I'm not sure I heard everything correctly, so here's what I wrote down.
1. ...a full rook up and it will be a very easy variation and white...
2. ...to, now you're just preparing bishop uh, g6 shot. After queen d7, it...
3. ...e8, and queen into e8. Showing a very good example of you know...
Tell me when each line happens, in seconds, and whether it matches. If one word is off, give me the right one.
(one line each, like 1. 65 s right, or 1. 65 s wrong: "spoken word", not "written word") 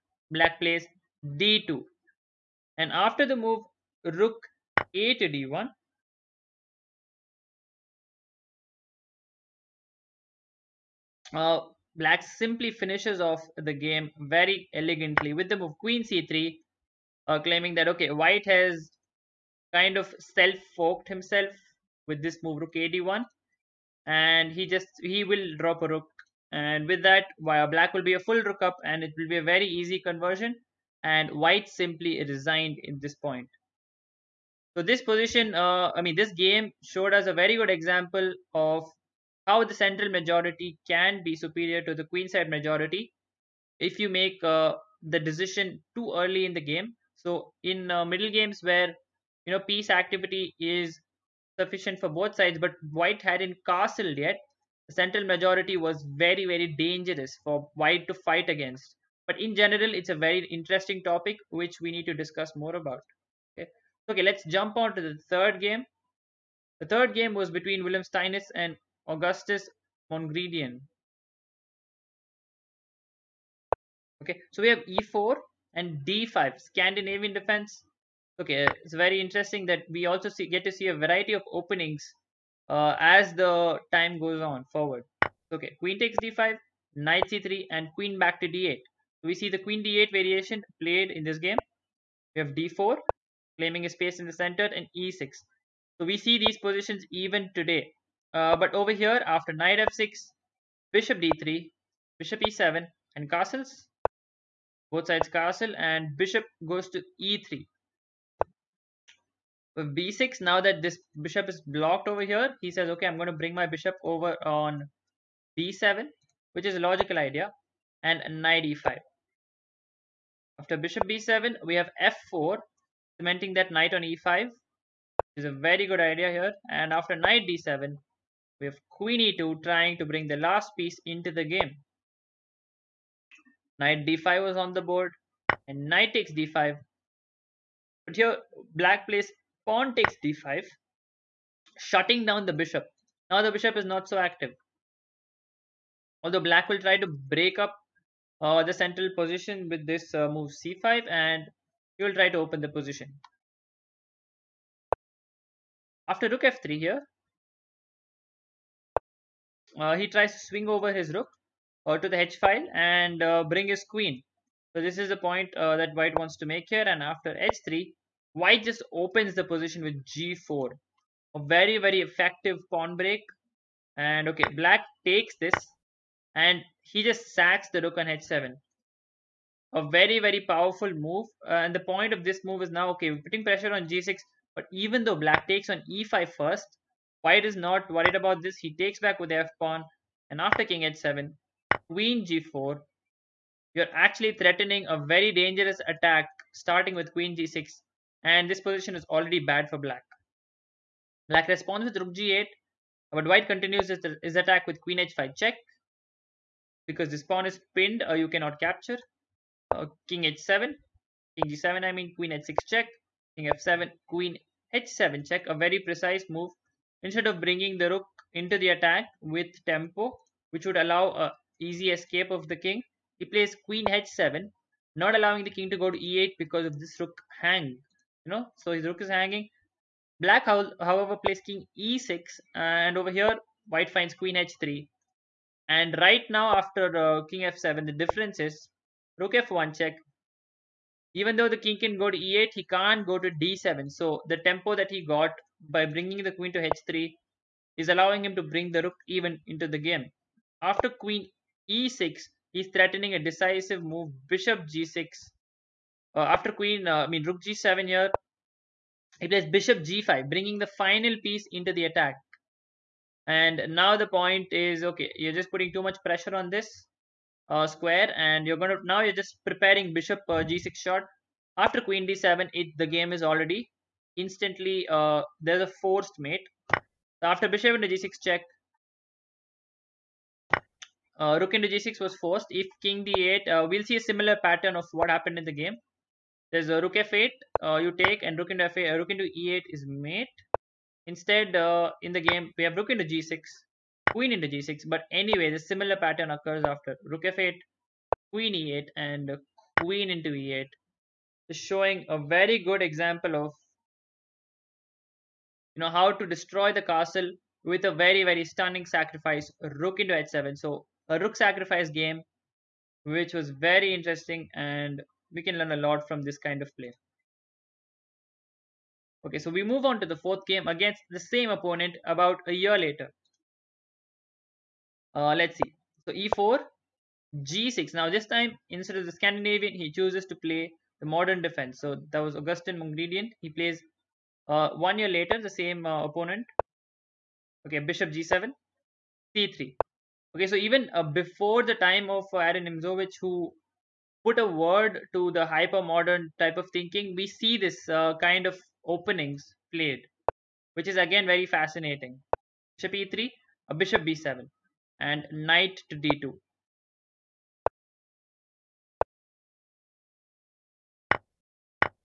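1. 28 s wrong: "conversion", not "variation"
2. 268 s right
3. 298 s right.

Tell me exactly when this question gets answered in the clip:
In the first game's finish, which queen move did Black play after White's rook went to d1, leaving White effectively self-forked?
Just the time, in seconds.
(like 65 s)
15 s.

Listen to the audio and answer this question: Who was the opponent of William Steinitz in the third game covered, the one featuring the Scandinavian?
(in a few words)
Augustus Mongredien.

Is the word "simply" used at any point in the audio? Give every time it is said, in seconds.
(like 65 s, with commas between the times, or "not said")
12 s, 31 s.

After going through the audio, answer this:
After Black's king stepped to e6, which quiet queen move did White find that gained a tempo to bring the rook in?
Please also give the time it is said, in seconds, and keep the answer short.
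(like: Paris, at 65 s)
Queen h3, at 234 s.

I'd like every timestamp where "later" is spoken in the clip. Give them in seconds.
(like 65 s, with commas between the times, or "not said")
322 s, 335 s.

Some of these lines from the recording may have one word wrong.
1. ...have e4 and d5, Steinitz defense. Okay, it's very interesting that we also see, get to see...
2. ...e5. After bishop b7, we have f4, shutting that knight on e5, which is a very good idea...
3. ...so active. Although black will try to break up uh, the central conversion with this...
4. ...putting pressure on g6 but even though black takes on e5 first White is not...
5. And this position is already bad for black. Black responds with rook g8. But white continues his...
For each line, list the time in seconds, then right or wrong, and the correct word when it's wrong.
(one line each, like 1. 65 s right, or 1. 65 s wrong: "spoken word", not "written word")
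1. 74 s wrong: "Scandinavian", not "Steinitz"
2. 118 s wrong: "cementing", not "shutting"
3. 144 s wrong: "position", not "conversion"
4. 183 s right
5. 198 s right.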